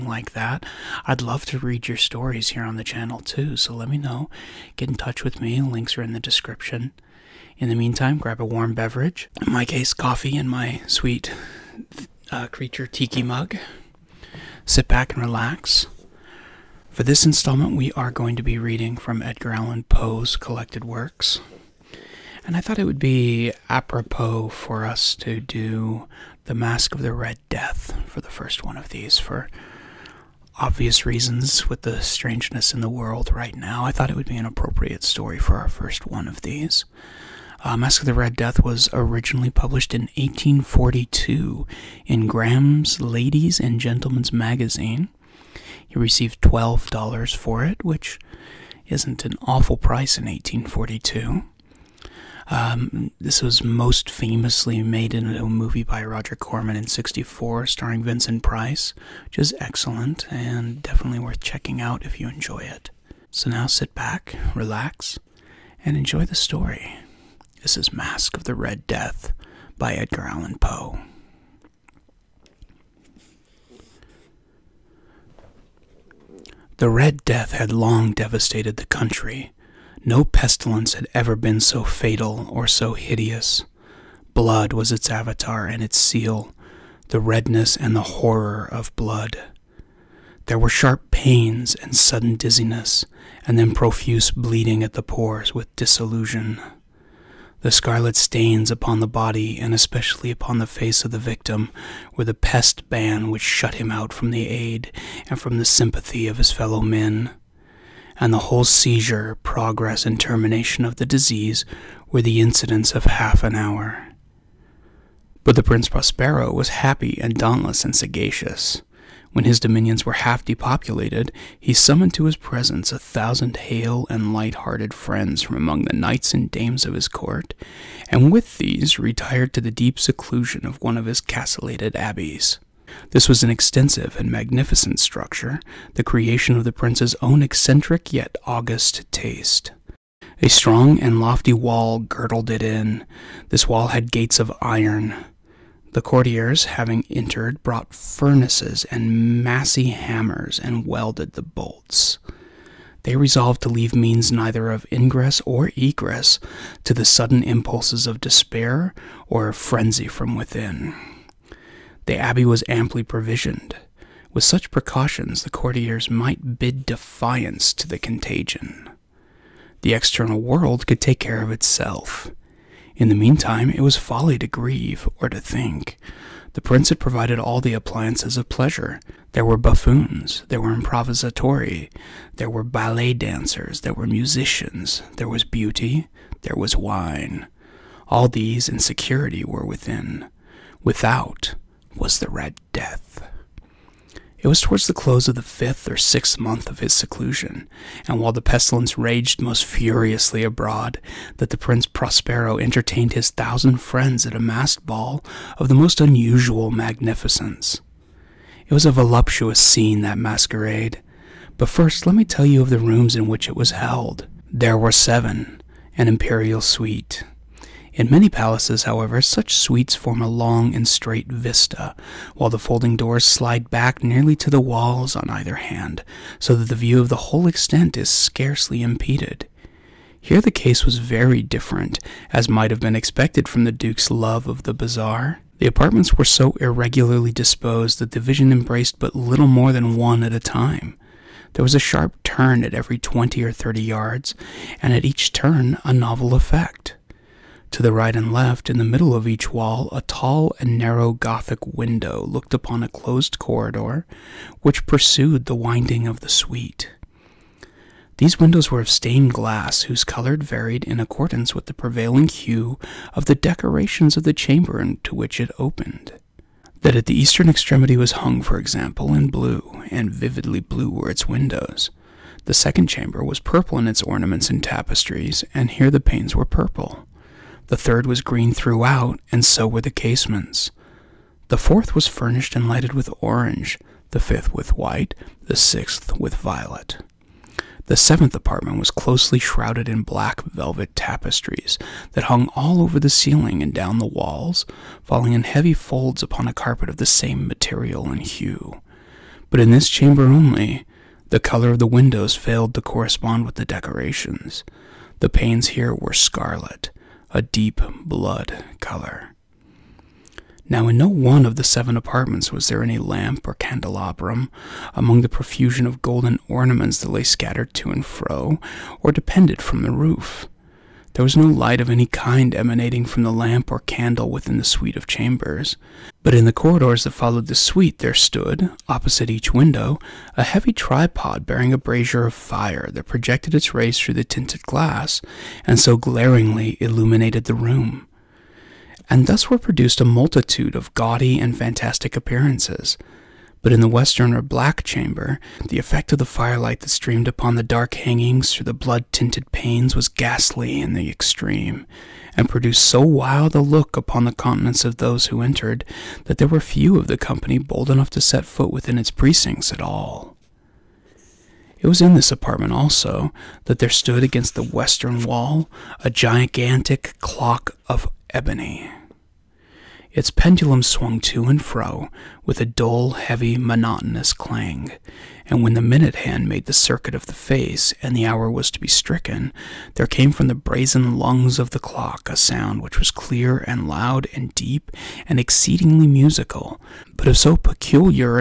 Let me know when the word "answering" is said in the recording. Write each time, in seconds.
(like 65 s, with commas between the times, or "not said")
not said.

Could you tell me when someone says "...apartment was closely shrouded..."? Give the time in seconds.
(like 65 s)
288 s.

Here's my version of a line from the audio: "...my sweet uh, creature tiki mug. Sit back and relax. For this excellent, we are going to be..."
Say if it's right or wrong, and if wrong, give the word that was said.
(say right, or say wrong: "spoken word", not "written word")
wrong: "installment", not "excellent".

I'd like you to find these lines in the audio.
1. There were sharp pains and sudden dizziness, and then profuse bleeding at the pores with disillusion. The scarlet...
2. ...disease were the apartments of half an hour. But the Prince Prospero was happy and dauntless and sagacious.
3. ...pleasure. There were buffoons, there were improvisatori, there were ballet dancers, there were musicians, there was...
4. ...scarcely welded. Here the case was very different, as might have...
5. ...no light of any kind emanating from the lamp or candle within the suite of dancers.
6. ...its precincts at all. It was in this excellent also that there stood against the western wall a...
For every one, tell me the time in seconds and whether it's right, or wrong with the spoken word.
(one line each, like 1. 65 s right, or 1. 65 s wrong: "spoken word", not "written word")
1. 90 s right
2. 111 s wrong: "incidents", not "apartments"
3. 178 s right
4. 228 s wrong: "impeded", not "welded"
5. 321 s wrong: "chambers", not "dancers"
6. 358 s wrong: "apartment", not "excellent".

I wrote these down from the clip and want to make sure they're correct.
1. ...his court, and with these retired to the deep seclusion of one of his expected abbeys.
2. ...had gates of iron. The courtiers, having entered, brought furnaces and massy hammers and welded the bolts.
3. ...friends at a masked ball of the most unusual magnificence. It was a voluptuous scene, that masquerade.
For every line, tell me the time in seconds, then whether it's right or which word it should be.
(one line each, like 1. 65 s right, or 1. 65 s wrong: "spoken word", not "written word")
1. 126 s wrong: "castellated", not "expected"
2. 143 s right
3. 203 s right.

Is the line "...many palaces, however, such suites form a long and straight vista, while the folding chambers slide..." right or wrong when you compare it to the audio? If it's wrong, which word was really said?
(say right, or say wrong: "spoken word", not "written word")
wrong: "doors", not "chambers".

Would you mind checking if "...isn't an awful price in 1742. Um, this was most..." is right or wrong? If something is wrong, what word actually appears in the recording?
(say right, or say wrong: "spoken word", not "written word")
wrong: "1842", not "1742".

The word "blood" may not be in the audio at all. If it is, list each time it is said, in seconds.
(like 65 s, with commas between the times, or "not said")
84 s, 88 s, 308 s, 348 s.